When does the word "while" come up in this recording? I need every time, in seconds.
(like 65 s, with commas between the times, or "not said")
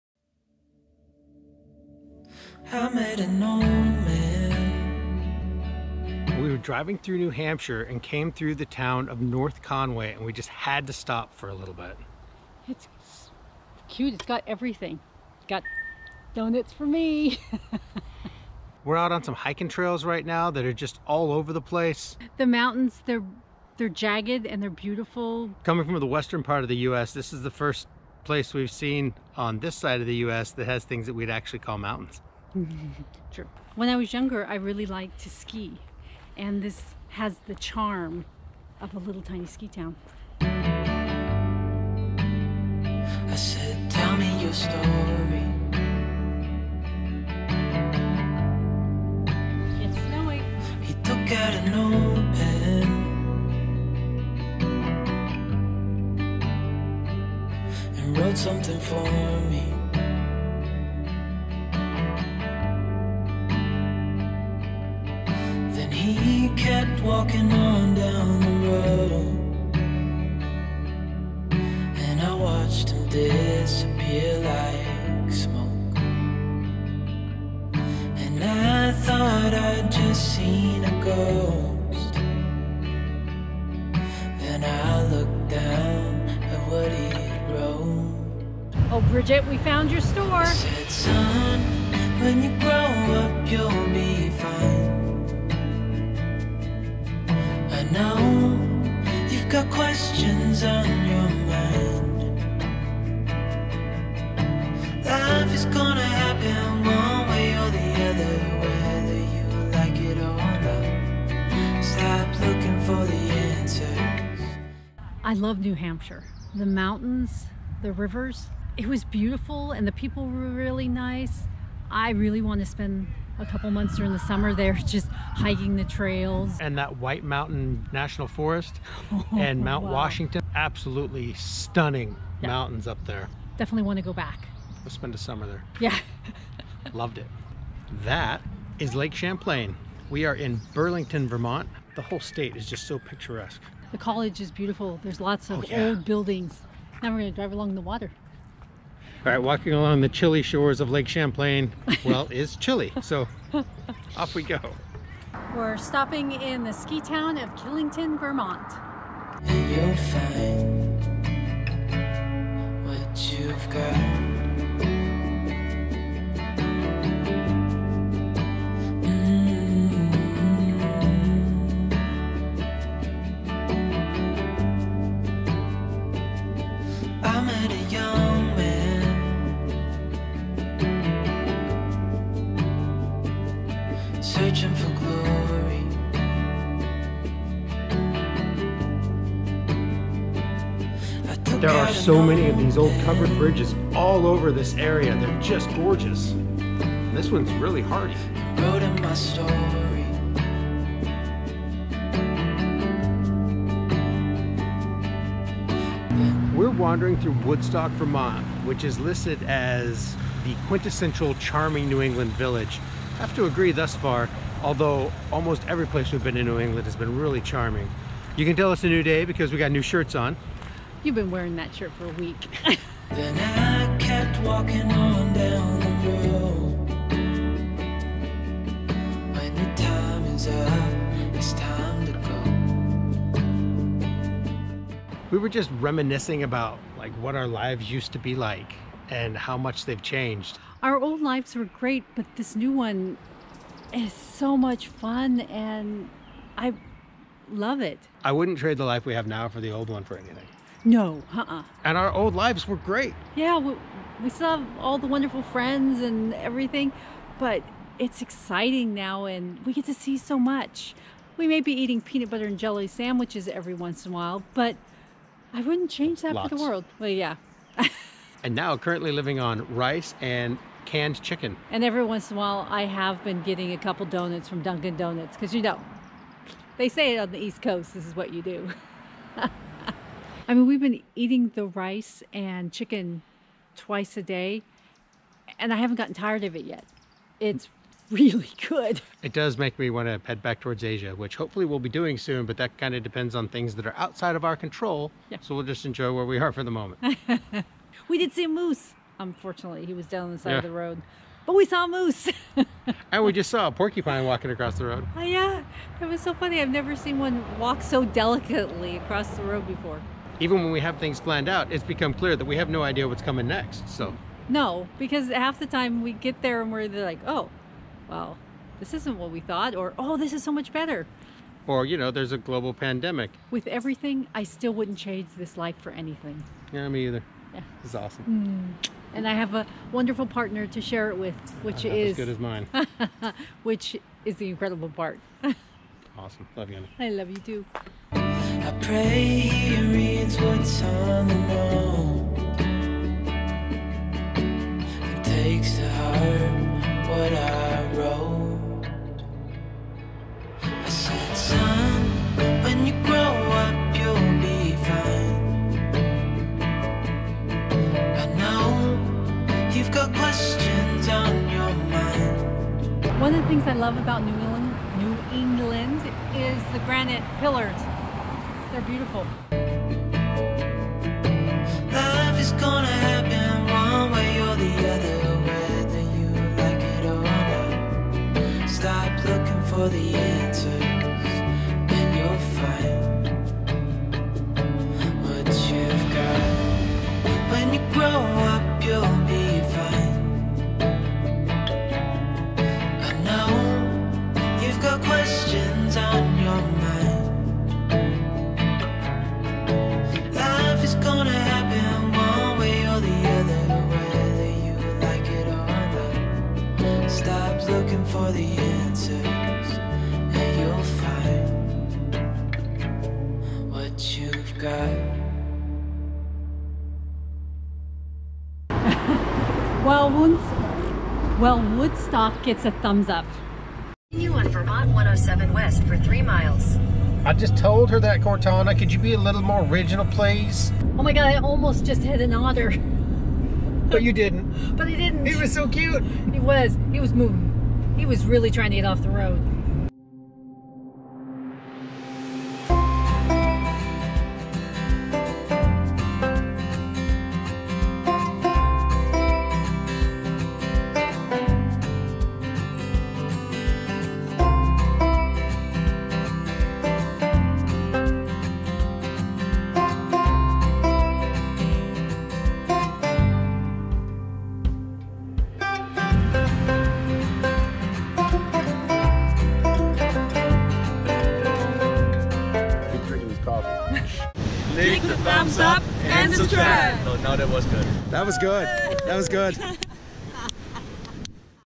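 264 s, 272 s.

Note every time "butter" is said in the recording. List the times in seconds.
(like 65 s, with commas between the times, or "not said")
262 s.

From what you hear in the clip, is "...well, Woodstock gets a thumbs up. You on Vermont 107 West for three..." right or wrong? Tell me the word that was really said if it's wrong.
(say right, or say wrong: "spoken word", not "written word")
right.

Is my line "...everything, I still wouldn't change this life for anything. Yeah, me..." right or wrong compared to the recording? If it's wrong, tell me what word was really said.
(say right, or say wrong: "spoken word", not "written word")
right.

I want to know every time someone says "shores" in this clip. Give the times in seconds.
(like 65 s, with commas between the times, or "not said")
150 s.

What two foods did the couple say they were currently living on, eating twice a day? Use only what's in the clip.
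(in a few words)
Rice and canned chicken.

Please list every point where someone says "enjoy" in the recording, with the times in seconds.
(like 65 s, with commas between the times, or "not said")
295 s.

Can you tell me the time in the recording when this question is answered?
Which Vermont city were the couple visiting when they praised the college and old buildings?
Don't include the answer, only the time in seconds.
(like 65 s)
140 s.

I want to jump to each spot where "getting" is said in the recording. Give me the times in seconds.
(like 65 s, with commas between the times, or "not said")
273 s.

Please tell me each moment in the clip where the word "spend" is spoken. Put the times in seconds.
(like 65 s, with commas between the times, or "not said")
122 s, 134 s.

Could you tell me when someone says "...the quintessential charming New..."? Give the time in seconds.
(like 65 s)
210 s.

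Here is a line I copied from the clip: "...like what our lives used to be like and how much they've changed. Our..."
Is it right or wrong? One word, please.
right.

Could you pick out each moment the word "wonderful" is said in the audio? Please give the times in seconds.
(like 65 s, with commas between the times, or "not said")
255 s, 329 s.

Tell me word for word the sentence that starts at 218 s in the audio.
You can tell it's a new day because we got new shirts on.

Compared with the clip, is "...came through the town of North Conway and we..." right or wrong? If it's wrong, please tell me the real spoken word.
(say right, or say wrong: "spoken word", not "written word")
right.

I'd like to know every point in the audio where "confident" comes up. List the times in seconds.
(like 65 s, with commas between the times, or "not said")
not said.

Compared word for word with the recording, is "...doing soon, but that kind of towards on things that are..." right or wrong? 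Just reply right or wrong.
wrong.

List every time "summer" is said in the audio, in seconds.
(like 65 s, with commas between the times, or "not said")
124 s, 135 s.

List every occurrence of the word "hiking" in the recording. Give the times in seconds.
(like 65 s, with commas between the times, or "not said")
19 s, 125 s.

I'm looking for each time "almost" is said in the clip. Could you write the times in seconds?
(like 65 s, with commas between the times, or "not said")
215 s, 431 s.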